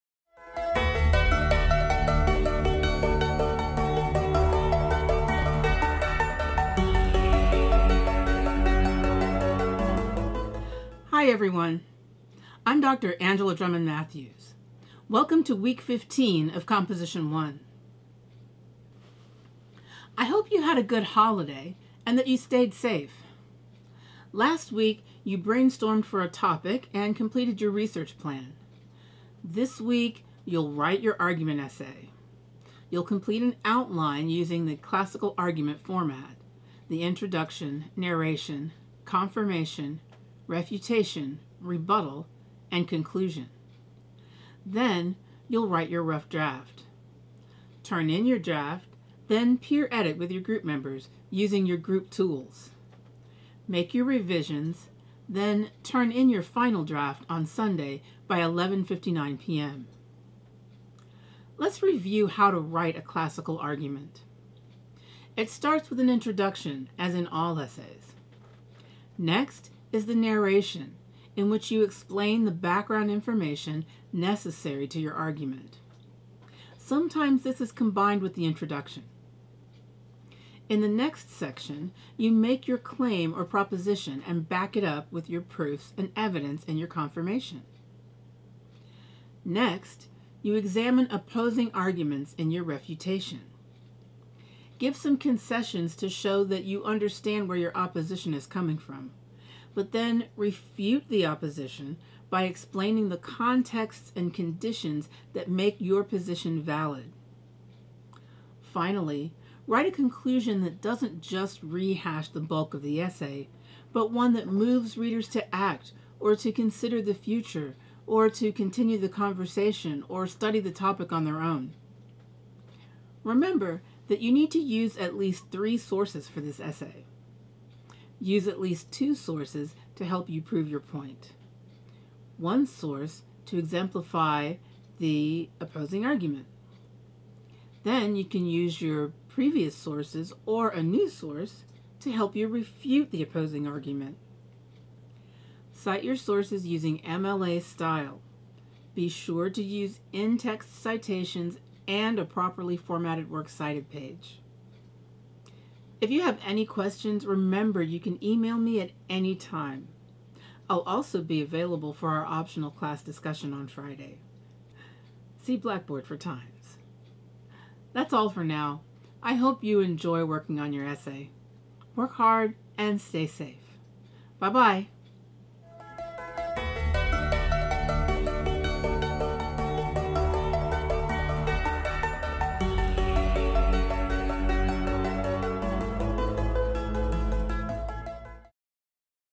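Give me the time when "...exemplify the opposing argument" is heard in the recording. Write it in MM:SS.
02:13.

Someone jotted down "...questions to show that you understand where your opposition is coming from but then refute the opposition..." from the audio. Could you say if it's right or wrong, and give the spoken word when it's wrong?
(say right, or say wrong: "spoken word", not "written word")
wrong: "concessions", not "questions".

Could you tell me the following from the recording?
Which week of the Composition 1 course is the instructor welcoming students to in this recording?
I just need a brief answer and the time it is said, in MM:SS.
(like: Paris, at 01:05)
15, at 00:15.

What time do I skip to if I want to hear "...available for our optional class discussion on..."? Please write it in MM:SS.
02:41.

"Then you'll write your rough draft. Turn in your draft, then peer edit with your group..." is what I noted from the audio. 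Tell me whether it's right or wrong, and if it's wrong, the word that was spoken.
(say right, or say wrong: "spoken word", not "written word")
right.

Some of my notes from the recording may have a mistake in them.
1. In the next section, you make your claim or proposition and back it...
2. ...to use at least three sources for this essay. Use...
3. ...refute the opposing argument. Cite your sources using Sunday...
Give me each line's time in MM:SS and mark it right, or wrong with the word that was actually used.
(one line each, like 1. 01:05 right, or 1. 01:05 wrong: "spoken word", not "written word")
1. 01:20 right
2. 02:04 right
3. 02:22 wrong: "MLA", not "Sunday".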